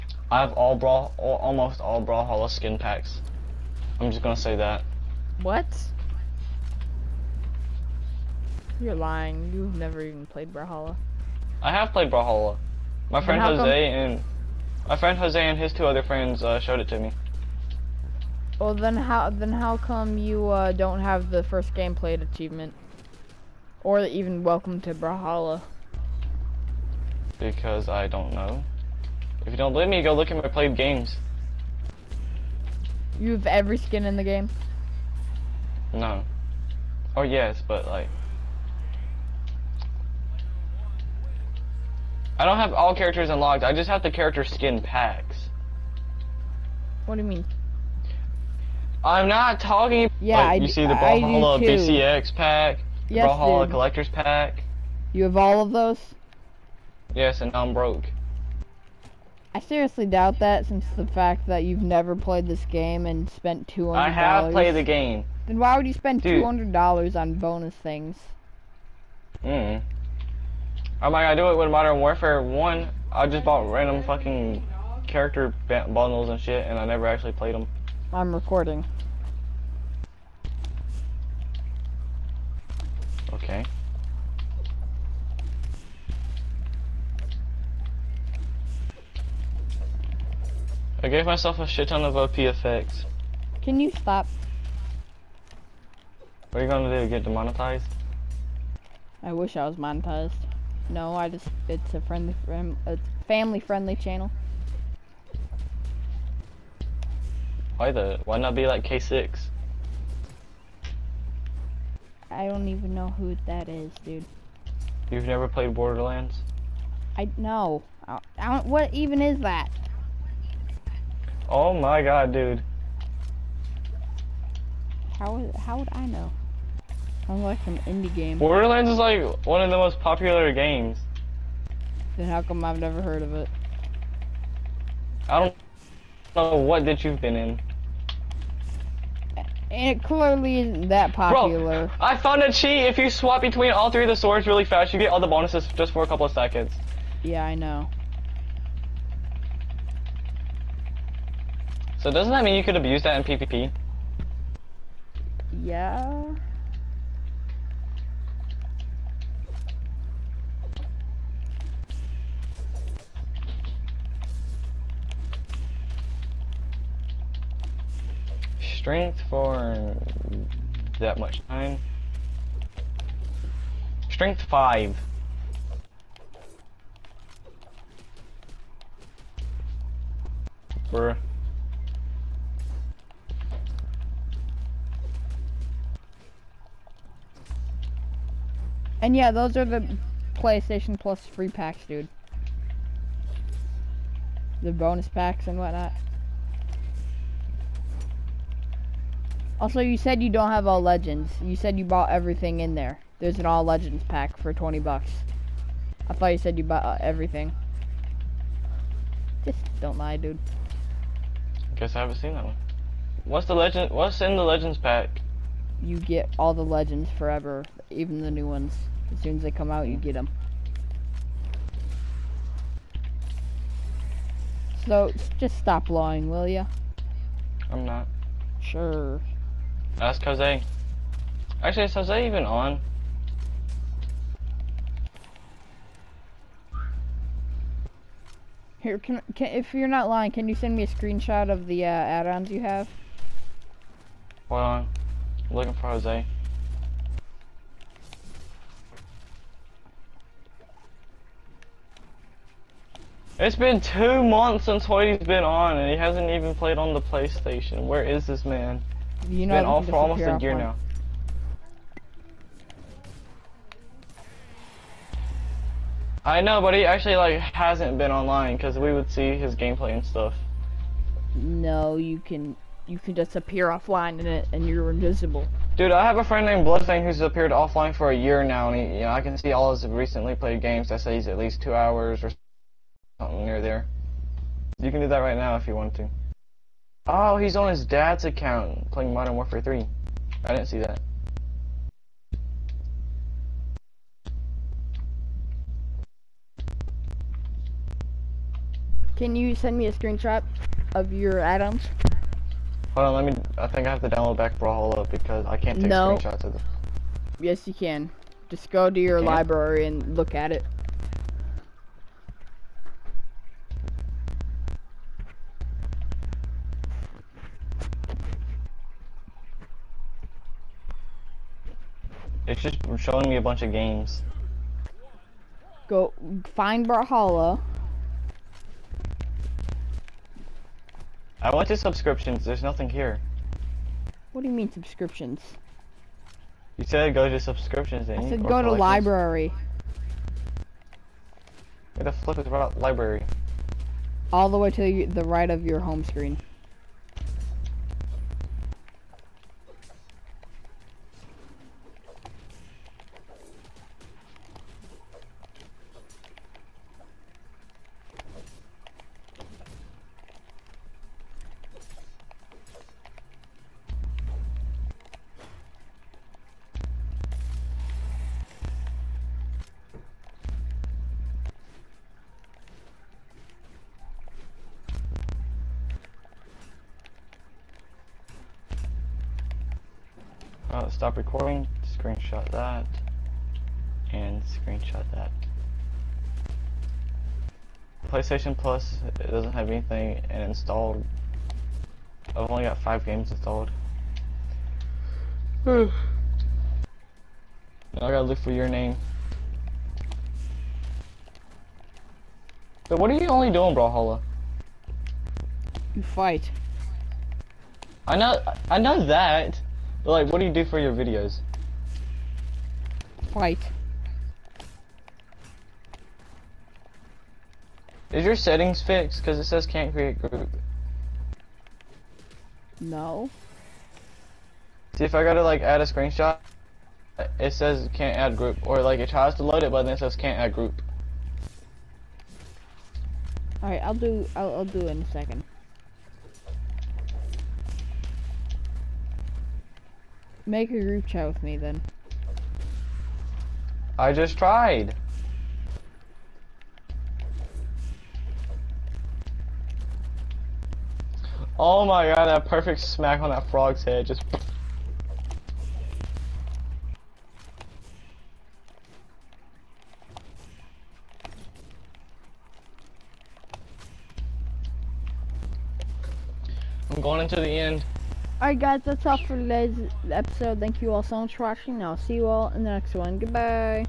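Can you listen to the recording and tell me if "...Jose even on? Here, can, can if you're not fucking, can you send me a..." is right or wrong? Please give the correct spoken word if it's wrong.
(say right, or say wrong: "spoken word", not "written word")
wrong: "lying", not "fucking".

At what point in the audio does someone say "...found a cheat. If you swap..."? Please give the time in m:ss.
2:22.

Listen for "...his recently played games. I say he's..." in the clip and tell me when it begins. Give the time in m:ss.
4:39.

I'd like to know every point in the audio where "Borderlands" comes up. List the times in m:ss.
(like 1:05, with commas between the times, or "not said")
1:55, 2:08.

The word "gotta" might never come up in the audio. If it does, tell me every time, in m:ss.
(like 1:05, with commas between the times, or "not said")
6:37, 7:05.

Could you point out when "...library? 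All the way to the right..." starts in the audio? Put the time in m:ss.
5:42.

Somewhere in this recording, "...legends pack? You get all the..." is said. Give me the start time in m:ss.
3:34.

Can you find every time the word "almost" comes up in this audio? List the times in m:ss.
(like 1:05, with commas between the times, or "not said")
0:01, 4:19.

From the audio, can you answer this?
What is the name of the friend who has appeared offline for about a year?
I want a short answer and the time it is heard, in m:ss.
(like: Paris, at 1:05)
Bloodthing, at 4:36.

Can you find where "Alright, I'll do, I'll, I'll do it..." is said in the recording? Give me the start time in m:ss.
7:13.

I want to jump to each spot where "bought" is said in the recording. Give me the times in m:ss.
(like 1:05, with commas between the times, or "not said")
1:13, 3:21, 3:26.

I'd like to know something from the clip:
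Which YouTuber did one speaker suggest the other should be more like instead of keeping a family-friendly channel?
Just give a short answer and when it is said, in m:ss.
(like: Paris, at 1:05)
K6, at 1:48.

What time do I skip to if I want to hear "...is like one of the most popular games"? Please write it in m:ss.
2:08.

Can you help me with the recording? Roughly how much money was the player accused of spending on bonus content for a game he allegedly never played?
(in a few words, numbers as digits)
$200.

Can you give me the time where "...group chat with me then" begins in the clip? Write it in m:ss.
7:20.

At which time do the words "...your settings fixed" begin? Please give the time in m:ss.
6:58.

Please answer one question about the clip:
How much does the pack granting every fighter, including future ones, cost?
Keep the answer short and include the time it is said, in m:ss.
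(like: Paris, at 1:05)
$20, at 3:24.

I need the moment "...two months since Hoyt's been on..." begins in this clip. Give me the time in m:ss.
4:13.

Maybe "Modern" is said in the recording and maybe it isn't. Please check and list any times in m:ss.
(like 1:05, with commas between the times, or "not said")
1:11, 4:49.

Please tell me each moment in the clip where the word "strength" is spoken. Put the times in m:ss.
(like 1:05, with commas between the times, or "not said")
2:48, 2:54.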